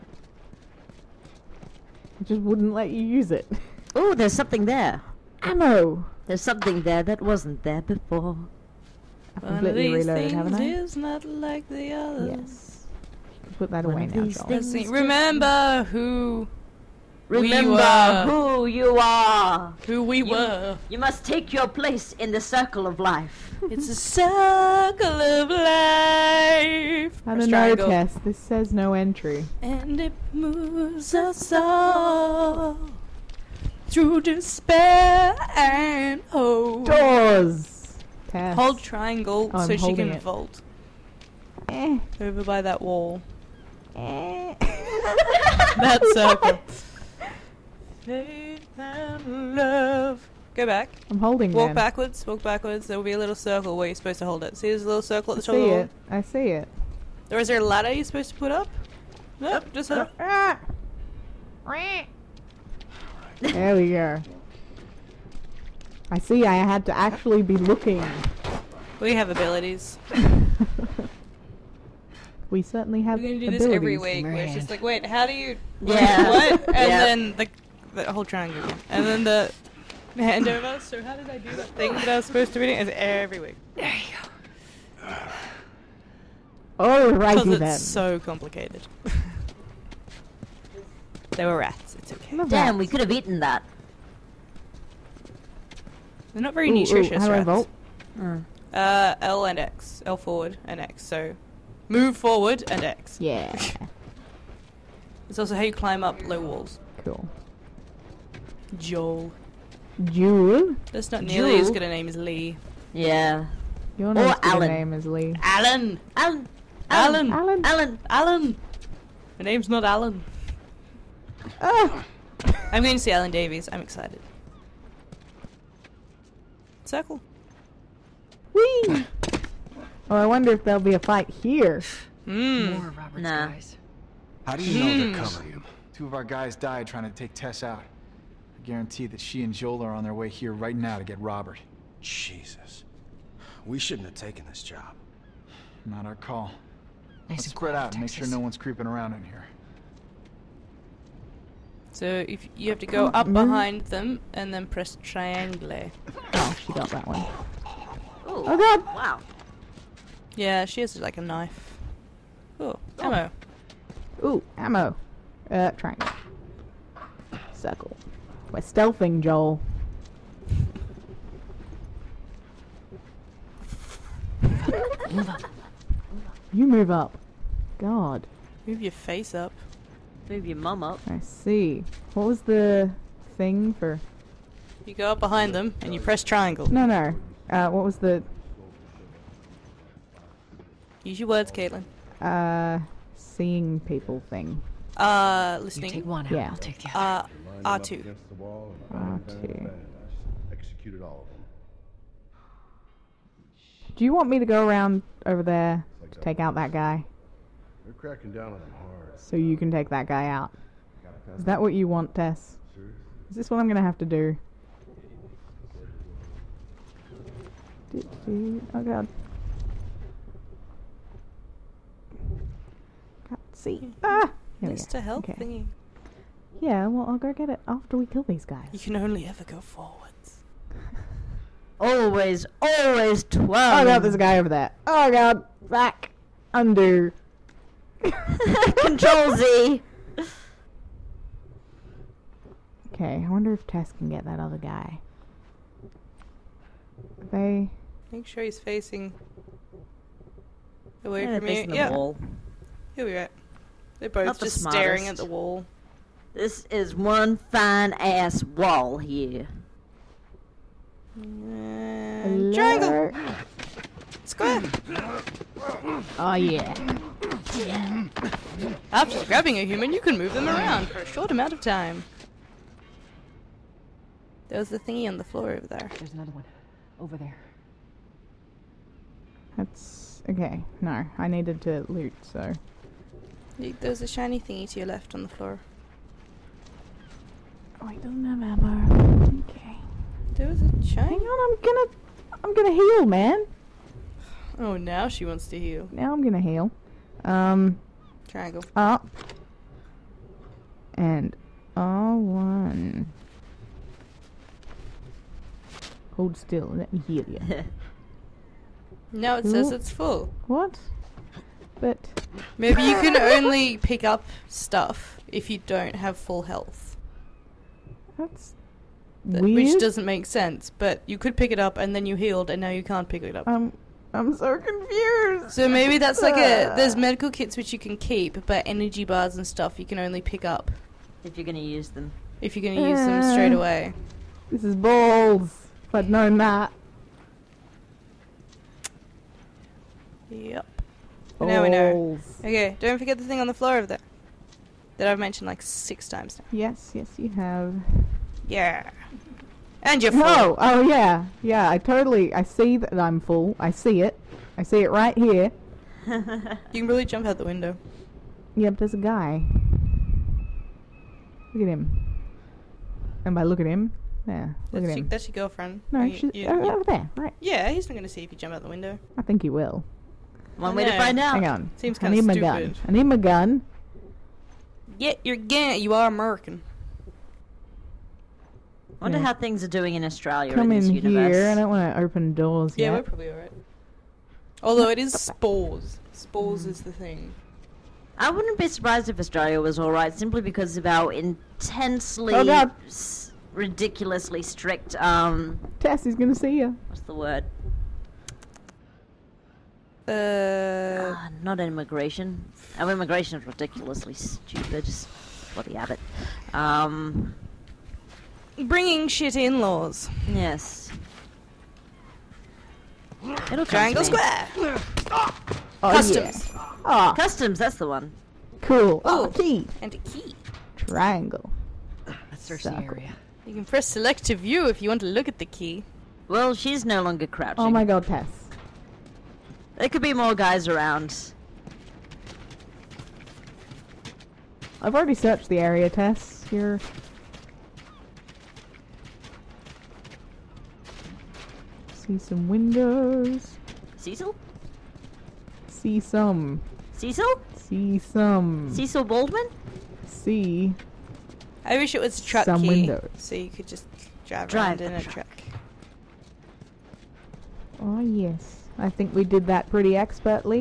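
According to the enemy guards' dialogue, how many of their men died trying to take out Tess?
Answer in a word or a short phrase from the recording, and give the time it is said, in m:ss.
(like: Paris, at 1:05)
2, at 2:15.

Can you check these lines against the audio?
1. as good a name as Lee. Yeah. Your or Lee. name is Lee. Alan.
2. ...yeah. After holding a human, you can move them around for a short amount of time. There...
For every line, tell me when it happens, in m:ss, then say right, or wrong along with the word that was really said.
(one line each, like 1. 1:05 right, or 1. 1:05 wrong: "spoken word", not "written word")
1. 1:51 wrong: "Alan", not "Lee"
2. 4:26 wrong: "grabbing", not "holding".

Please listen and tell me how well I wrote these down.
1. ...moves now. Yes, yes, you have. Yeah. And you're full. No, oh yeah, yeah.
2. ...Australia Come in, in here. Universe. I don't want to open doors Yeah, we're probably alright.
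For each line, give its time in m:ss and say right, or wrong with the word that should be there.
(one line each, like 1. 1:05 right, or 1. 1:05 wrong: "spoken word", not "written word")
1. 5:46 wrong: "times", not "moves"
2. 6:20 right.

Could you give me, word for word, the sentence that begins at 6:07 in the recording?
Yeah, he's not going to see if you jump out the window.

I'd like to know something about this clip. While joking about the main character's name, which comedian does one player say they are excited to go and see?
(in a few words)
Alan Davies.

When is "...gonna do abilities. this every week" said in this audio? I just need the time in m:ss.
1:13.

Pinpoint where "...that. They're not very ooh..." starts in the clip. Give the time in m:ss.
1:33.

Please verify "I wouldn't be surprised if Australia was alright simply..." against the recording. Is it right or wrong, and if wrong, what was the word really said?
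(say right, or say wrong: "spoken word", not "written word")
right.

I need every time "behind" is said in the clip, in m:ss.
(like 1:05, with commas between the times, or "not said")
2:33, 3:05.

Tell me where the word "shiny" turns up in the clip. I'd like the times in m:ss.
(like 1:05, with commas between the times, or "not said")
4:44, 4:50.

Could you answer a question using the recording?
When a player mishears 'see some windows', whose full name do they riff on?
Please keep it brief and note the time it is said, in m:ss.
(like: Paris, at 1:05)
Cecil Baldwin, at 7:28.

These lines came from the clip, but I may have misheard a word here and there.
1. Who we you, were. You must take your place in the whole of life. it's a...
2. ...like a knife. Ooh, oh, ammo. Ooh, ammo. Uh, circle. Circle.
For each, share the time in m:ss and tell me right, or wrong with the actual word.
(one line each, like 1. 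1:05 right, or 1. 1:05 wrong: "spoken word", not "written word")
1. 0:19 wrong: "circle", not "whole"
2. 2:40 wrong: "triangle", not "circle".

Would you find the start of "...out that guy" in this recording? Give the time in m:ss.
3:26.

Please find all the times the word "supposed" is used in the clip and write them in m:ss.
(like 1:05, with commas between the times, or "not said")
0:53, 0:58, 1:22.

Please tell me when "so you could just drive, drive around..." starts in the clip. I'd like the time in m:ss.
7:33.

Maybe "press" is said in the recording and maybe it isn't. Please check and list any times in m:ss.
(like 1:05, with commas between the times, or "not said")
2:34, 3:05, 7:03.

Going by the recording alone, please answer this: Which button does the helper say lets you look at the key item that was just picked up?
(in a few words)
select.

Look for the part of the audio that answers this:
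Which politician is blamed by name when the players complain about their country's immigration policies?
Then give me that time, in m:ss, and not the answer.
6:45.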